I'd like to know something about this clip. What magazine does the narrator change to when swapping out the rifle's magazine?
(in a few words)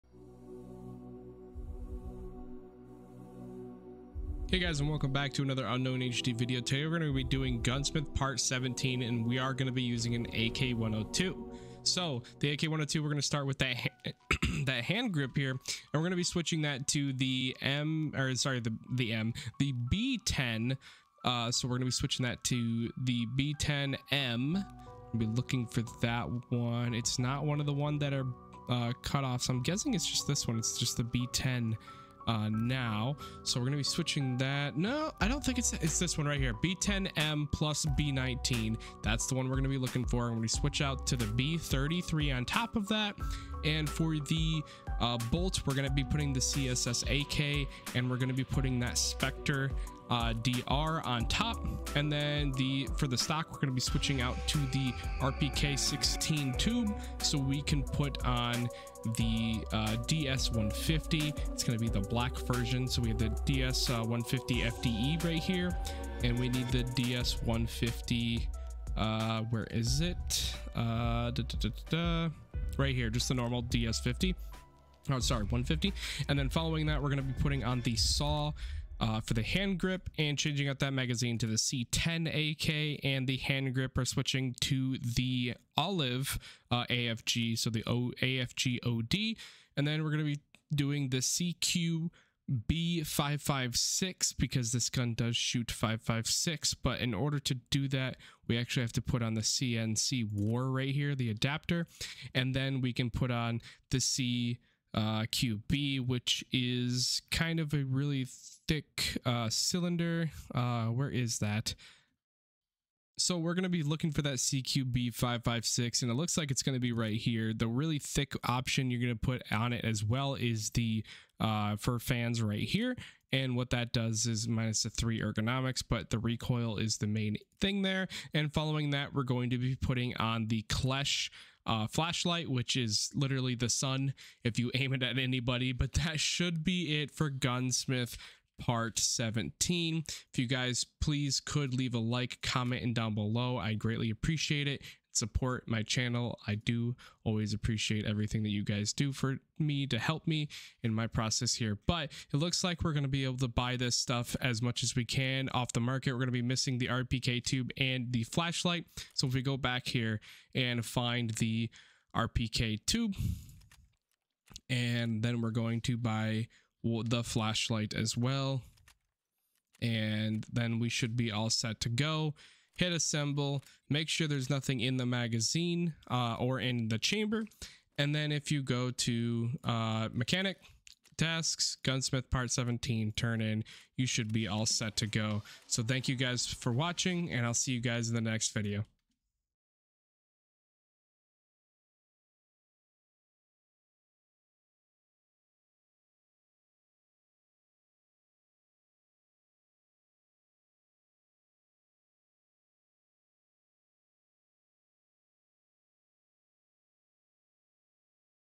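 C10AK.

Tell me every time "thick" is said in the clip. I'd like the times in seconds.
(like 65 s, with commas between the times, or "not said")
108 s, 117 s.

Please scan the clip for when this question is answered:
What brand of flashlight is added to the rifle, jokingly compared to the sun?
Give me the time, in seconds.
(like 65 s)
130 s.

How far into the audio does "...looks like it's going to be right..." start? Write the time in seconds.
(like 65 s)
116 s.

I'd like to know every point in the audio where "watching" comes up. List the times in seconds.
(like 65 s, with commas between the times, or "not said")
186 s.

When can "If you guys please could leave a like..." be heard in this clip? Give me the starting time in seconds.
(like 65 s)
140 s.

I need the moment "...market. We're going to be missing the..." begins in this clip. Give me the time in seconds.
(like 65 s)
155 s.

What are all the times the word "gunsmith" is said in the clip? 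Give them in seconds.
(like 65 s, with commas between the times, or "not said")
7 s, 137 s, 181 s.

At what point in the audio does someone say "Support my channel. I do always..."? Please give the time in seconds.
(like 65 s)
145 s.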